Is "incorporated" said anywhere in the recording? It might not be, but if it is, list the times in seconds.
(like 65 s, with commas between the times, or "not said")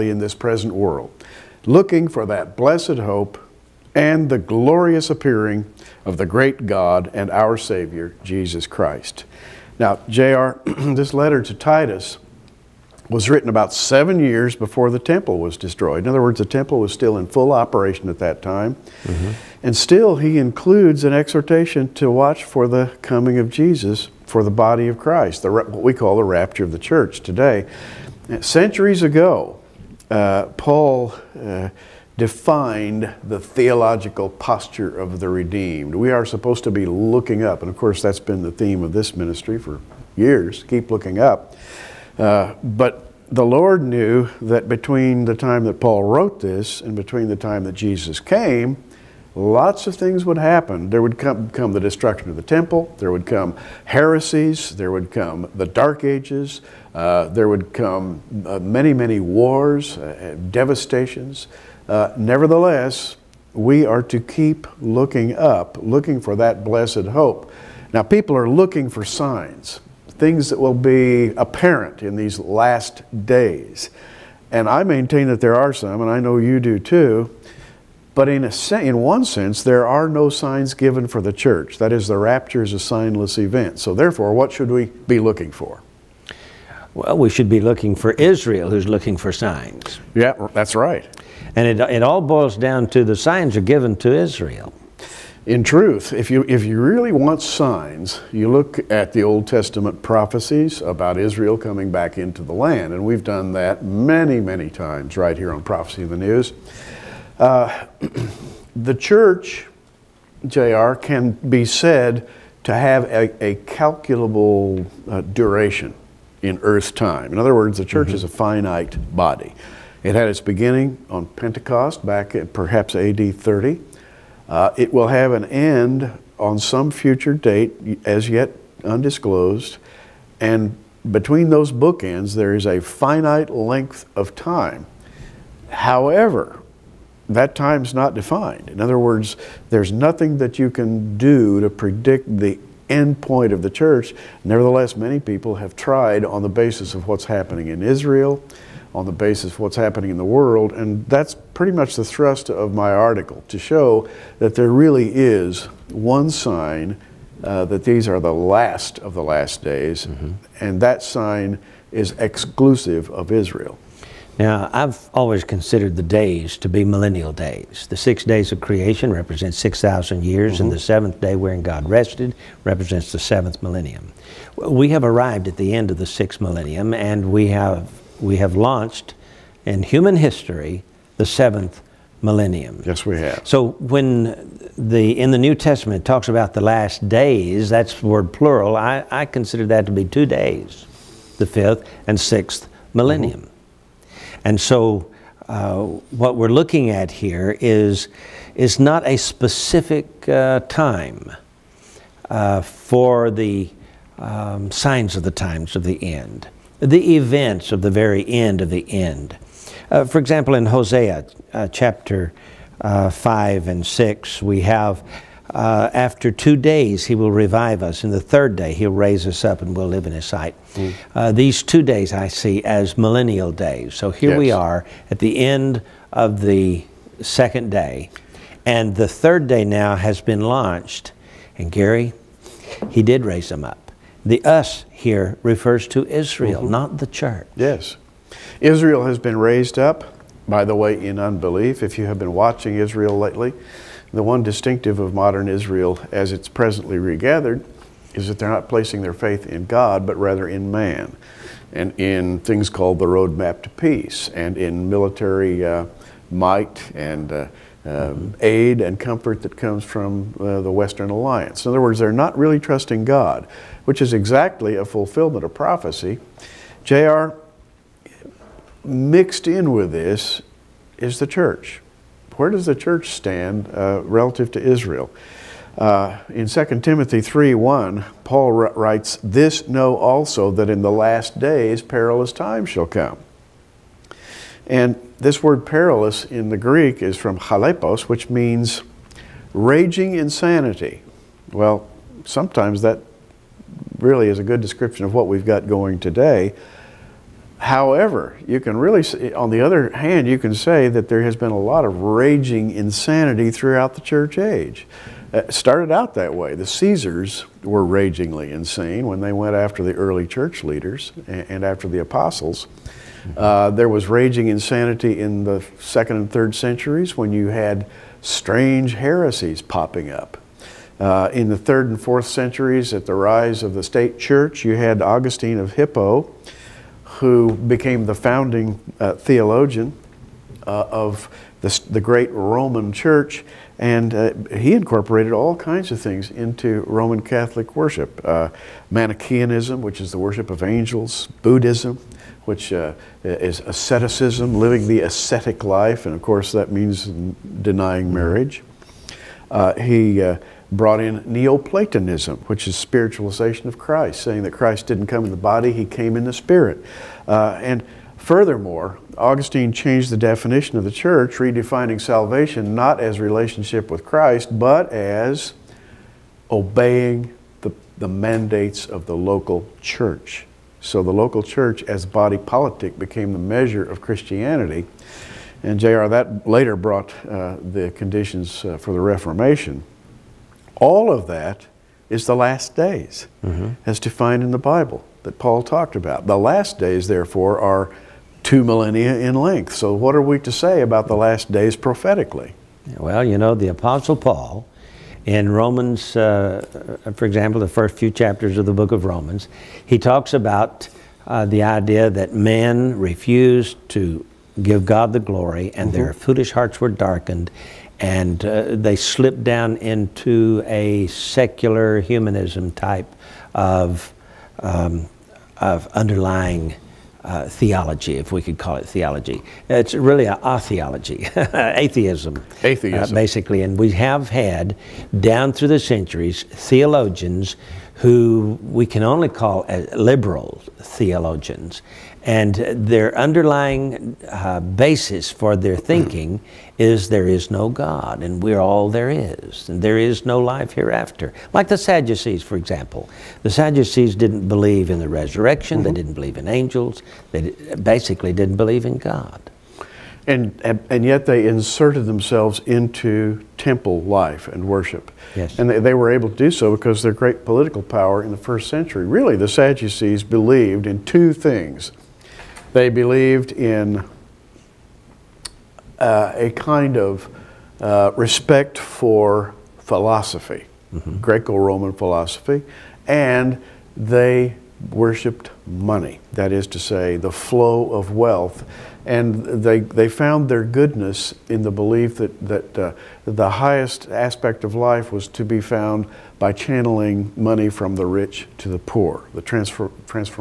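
334 s.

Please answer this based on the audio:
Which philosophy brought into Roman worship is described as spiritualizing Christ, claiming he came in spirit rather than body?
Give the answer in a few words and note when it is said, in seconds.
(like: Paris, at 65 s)
Neoplatonism, at 351 s.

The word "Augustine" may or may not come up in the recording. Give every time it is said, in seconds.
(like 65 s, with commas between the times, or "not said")
325 s, 359 s.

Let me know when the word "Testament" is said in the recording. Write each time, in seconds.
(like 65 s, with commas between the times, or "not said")
99 s, 185 s.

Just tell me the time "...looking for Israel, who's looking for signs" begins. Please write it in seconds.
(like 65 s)
87 s.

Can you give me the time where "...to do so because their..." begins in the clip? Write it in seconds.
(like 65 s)
456 s.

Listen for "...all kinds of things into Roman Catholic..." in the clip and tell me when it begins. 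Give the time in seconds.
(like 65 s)
335 s.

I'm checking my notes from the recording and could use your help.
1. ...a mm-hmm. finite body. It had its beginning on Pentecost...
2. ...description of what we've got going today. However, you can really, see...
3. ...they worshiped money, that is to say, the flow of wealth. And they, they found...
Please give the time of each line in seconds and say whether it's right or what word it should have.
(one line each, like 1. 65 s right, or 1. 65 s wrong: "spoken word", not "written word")
1. 118 s right
2. 294 s right
3. 473 s right.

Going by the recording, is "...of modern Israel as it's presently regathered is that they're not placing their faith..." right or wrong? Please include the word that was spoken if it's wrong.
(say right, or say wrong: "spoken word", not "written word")
right.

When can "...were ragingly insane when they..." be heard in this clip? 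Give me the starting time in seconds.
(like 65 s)
307 s.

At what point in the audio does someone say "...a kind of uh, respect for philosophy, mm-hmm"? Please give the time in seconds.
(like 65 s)
466 s.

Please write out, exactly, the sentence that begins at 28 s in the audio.
Centuries ago, uh, Paul uh, defined the theological posture of the redeemed.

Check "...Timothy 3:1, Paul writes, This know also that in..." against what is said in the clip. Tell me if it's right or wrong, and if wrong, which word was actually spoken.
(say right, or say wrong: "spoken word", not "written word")
right.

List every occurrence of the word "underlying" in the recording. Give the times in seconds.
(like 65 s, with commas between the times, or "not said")
415 s, 433 s.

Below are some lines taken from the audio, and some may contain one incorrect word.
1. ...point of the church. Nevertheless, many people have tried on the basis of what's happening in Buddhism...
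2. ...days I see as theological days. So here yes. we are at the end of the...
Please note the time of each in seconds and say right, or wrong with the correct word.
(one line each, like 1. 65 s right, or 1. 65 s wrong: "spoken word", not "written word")
1. 143 s wrong: "Israel", not "Buddhism"
2. 221 s wrong: "millennial", not "theological".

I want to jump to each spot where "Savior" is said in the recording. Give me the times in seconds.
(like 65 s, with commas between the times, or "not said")
7 s.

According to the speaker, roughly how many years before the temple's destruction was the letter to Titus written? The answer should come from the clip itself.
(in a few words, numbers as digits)
7.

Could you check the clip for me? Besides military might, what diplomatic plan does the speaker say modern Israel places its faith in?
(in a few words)
the roadmap to peace.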